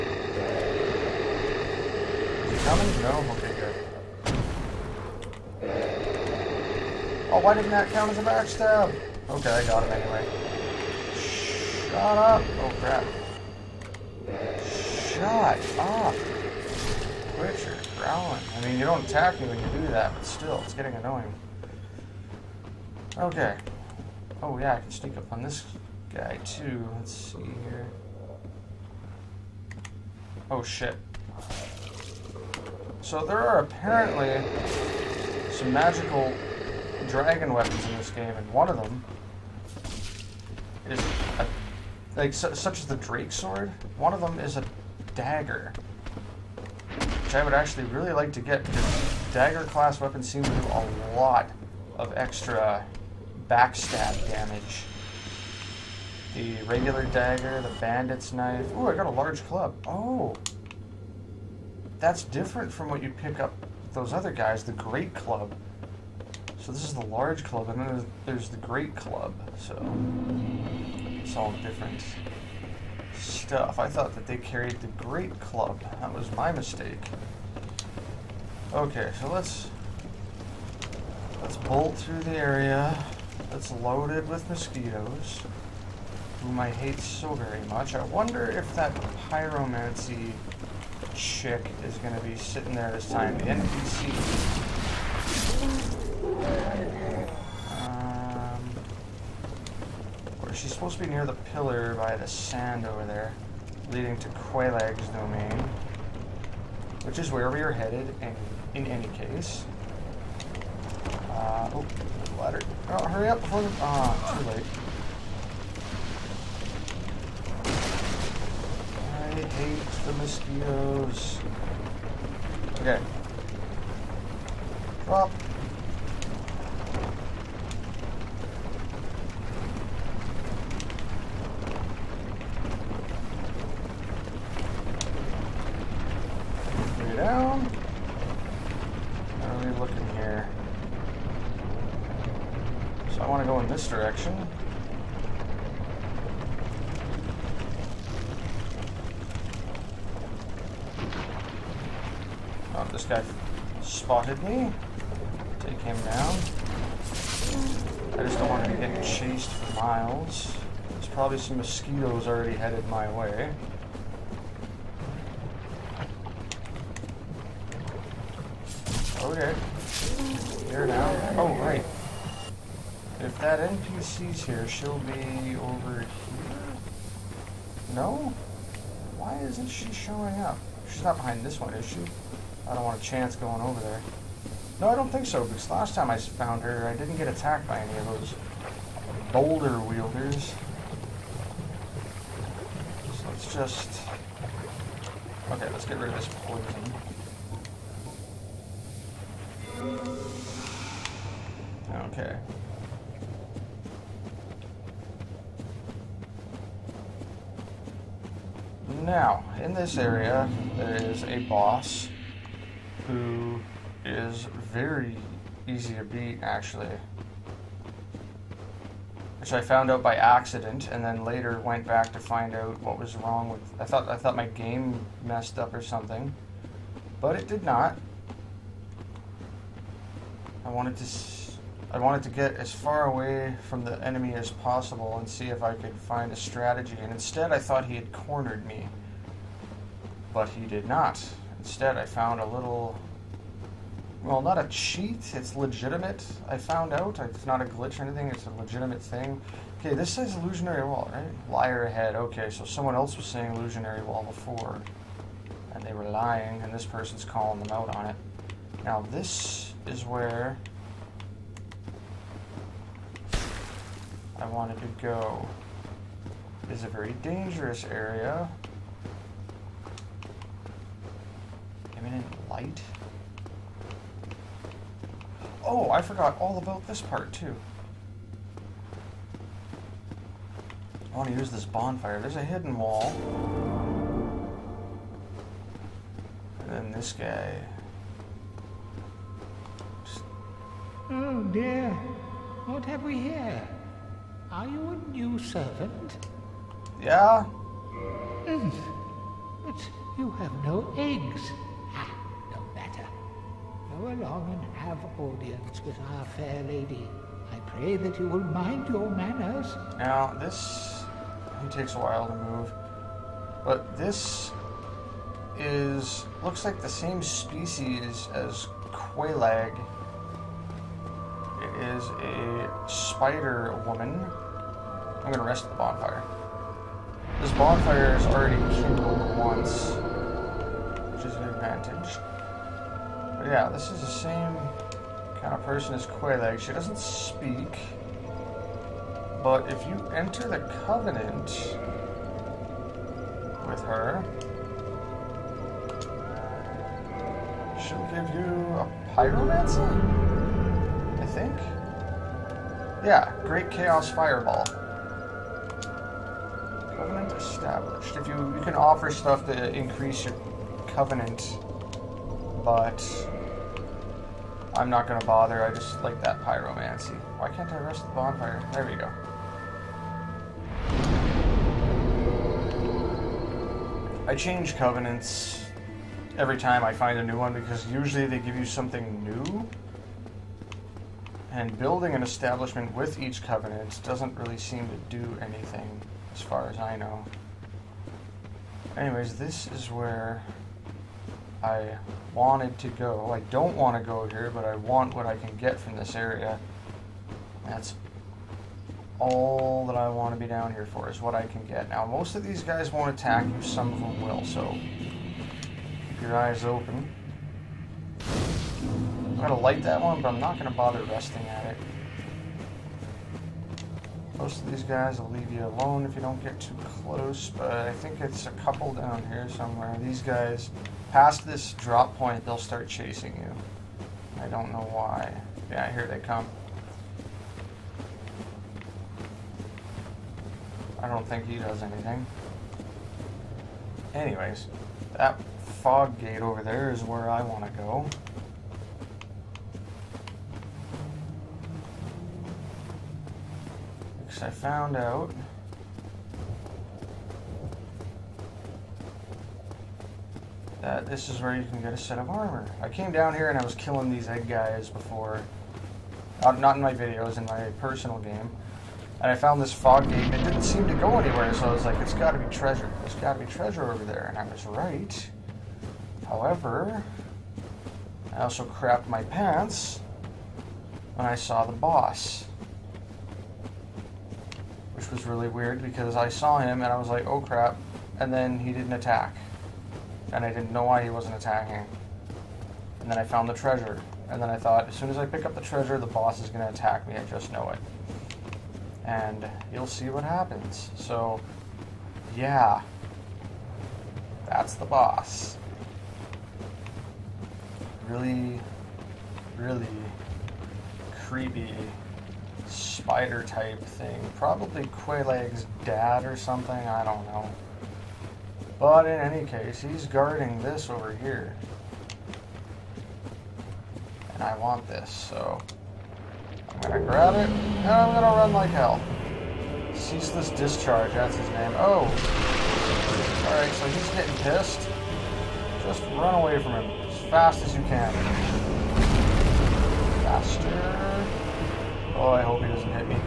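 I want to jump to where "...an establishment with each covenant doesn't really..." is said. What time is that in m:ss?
6:22.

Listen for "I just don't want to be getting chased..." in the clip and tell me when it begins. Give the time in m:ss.
2:38.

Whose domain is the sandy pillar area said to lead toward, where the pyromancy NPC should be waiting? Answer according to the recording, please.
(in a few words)
Quelaag's domain.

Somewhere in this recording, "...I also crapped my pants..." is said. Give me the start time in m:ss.
7:48.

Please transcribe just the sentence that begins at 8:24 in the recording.
Probably Quelaag's dad or something, I don't know.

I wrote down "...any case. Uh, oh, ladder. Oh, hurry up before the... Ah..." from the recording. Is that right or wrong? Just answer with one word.
right.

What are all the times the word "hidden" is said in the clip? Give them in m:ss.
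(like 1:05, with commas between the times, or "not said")
4:42.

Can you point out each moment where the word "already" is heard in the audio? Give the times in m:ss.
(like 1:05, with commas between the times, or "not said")
2:42, 5:28.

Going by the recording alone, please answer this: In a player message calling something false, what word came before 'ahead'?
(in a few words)
Liar.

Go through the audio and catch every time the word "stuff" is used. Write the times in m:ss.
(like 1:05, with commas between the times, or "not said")
1:13, 5:59.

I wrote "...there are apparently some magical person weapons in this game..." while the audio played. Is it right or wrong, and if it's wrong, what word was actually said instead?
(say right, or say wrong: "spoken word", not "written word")
wrong: "dragon", not "person".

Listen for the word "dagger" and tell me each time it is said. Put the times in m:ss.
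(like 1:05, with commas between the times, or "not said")
0:45, 0:49, 0:57.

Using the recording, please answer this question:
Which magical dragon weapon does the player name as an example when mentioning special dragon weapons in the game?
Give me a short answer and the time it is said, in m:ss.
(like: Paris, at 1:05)
Drake sword, at 0:42.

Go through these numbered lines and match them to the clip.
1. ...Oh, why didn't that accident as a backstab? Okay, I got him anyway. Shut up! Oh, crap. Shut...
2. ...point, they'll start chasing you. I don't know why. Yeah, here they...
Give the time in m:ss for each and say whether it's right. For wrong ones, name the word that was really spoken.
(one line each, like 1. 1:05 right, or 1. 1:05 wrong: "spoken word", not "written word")
1. 0:07 wrong: "count", not "accident"
2. 7:02 right.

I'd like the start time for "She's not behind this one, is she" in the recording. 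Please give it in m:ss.
3:00.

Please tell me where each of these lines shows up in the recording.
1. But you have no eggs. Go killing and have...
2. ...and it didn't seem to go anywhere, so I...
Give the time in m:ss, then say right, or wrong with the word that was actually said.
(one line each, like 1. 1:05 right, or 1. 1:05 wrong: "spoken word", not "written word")
1. 4:59 wrong: "along", not "killing"
2. 7:40 right.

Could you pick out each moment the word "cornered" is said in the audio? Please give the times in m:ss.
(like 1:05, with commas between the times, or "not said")
3:58.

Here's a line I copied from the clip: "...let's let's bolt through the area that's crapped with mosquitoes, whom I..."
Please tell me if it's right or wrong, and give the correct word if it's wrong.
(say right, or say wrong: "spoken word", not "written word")
wrong: "loaded", not "crapped".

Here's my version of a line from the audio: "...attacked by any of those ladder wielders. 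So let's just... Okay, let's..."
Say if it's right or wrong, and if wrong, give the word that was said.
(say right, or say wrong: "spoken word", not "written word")
wrong: "boulder", not "ladder".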